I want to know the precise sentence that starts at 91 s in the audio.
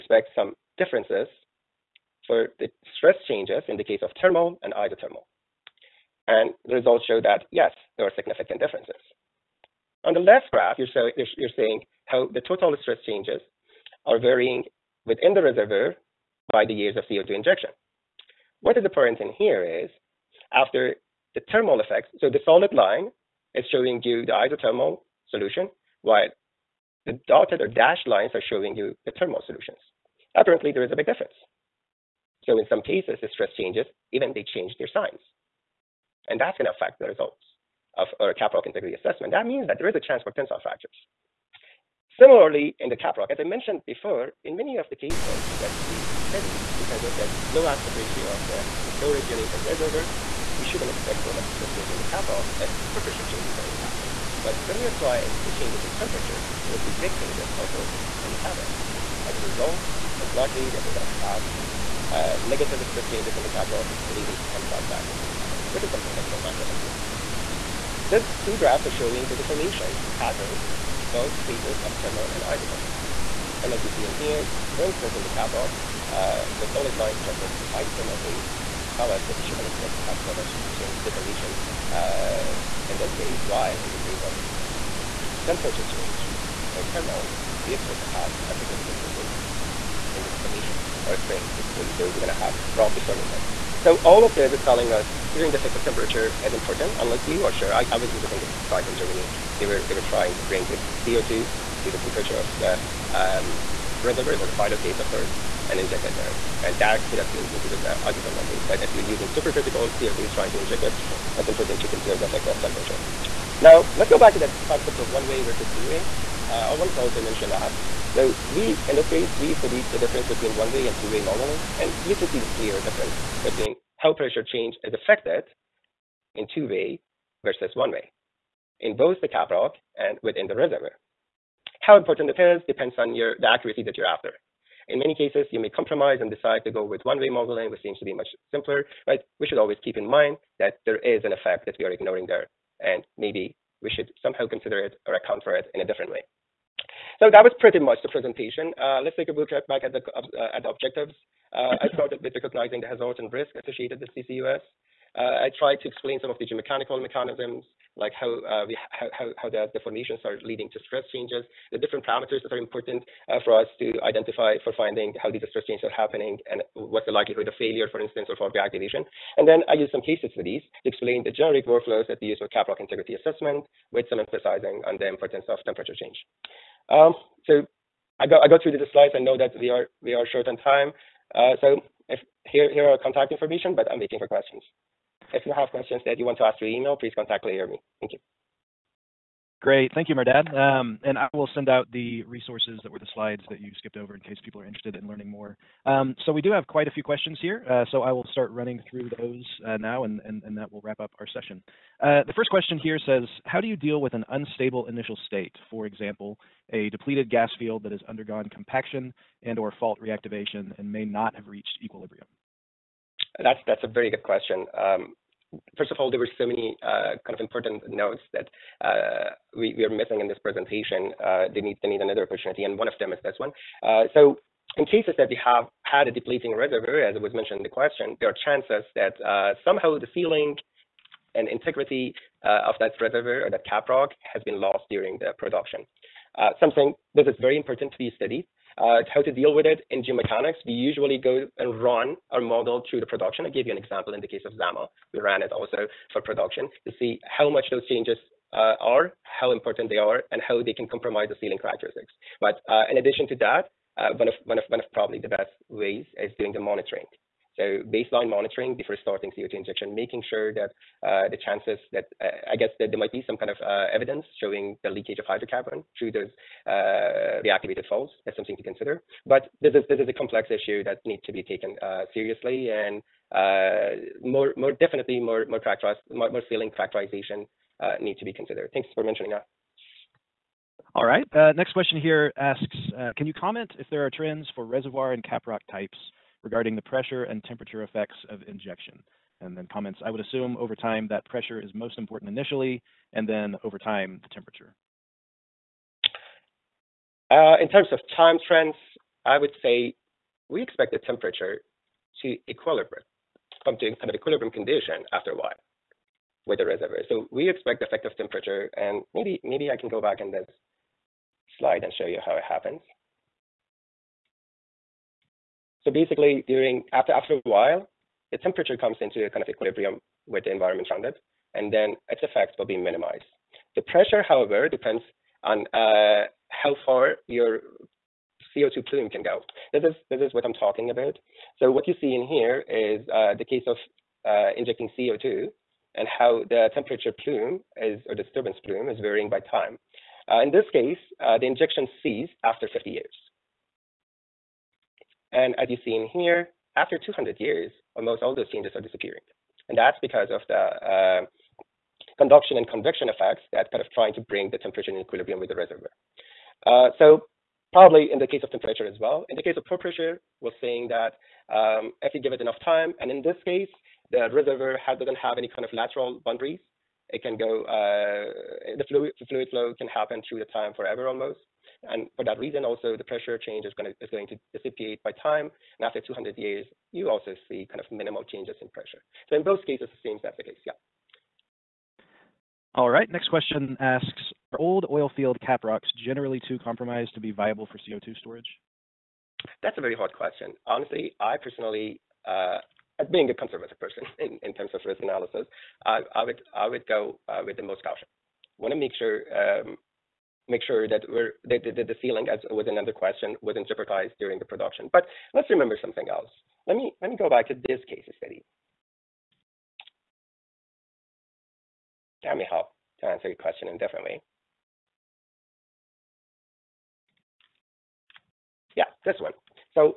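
So we're going to have rock deforming there.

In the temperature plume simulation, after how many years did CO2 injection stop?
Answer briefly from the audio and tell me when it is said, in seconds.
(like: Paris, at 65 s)
50, at 342 s.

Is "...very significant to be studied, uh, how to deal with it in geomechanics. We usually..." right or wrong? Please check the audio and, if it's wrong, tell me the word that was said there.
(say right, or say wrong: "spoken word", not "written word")
wrong: "important", not "significant".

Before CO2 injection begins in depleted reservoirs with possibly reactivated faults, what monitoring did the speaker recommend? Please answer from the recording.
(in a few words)
Baseline monitoring.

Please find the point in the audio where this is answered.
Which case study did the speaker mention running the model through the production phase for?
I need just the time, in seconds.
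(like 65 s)
244 s.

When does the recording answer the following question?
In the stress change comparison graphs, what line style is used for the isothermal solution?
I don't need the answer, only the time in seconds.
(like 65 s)
22 s.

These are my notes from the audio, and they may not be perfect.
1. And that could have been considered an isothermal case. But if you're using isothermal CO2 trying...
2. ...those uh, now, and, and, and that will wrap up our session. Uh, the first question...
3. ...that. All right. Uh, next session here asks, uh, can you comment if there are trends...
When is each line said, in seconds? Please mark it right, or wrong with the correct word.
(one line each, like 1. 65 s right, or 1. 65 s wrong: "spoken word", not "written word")
1. 106 s wrong: "supercritical", not "isothermal"
2. 199 s right
3. 279 s wrong: "question", not "session".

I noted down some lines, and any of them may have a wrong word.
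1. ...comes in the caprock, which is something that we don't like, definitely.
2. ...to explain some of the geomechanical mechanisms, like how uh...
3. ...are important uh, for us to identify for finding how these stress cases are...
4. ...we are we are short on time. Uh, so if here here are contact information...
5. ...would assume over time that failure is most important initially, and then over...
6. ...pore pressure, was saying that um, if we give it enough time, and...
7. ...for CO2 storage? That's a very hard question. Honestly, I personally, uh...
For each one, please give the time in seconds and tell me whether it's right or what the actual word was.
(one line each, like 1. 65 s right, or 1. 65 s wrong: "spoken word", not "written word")
1. 64 s wrong: "fractures", not "comes"
2. 155 s right
3. 162 s wrong: "changes", not "cases"
4. 179 s right
5. 290 s wrong: "pressure", not "failure"
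6. 359 s right
7. 387 s right.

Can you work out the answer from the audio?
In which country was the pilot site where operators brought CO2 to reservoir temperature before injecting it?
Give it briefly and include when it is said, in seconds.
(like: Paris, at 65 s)
Germany, at 98 s.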